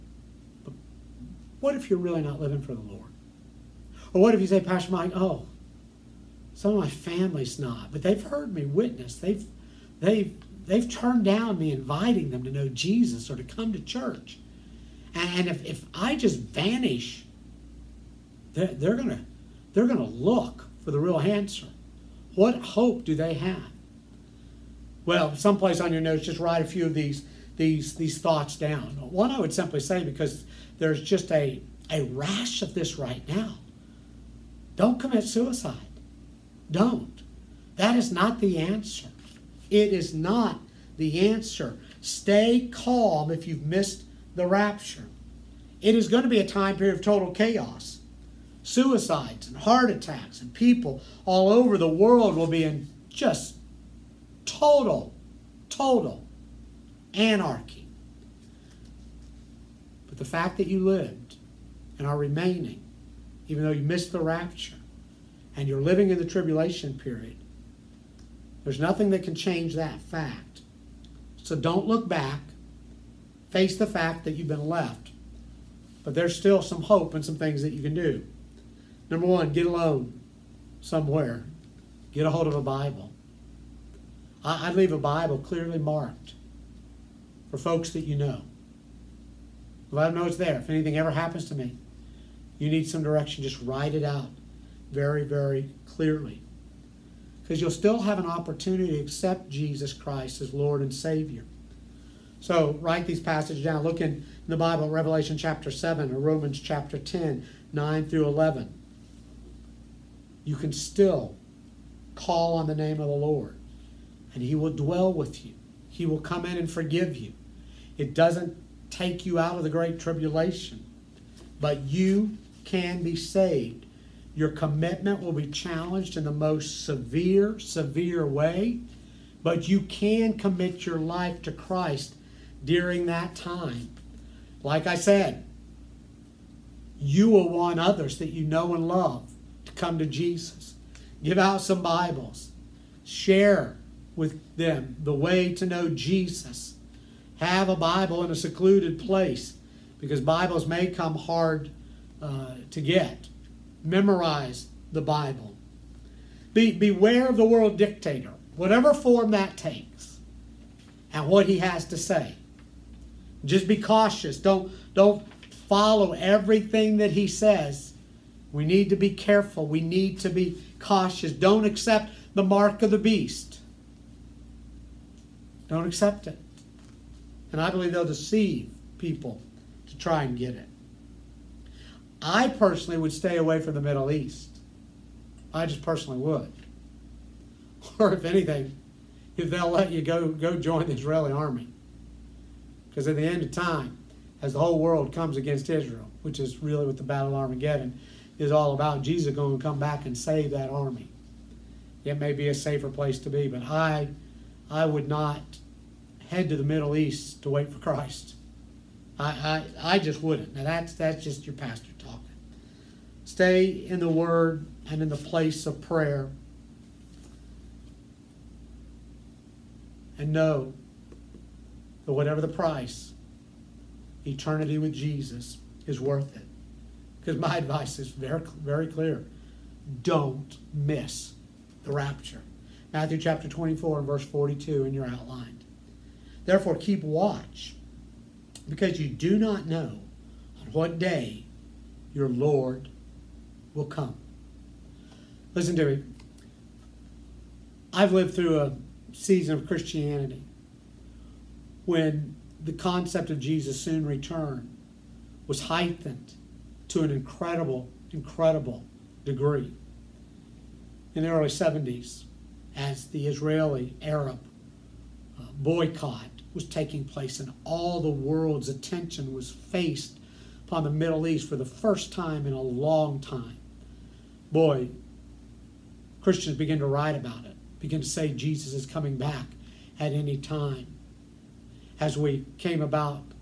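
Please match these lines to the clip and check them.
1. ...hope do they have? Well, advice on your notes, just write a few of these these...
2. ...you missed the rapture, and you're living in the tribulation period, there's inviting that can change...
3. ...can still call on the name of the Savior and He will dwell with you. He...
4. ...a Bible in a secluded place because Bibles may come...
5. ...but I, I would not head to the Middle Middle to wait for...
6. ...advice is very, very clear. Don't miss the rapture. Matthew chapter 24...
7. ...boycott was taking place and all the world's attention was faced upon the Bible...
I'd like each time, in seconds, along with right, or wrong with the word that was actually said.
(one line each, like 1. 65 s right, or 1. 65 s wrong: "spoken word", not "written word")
1. 22 s wrong: "someplace", not "advice"
2. 63 s wrong: "nothing", not "inviting"
3. 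110 s wrong: "Lord", not "Savior"
4. 147 s right
5. 203 s wrong: "East", not "Middle"
6. 227 s right
7. 265 s wrong: "Middle", not "Bible".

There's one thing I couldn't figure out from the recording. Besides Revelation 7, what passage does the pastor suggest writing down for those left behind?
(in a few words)
Romans 10:9-11.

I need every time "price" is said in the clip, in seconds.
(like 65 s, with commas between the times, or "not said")
222 s.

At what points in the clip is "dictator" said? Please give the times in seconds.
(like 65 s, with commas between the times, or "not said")
157 s.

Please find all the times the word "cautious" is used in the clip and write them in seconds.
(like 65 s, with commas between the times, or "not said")
163 s, 170 s.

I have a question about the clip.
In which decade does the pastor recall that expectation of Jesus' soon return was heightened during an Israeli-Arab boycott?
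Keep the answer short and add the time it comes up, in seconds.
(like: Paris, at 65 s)
Early 70s, at 261 s.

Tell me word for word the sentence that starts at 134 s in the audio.
Like I said, you will want others that you know and love to come to Jesus.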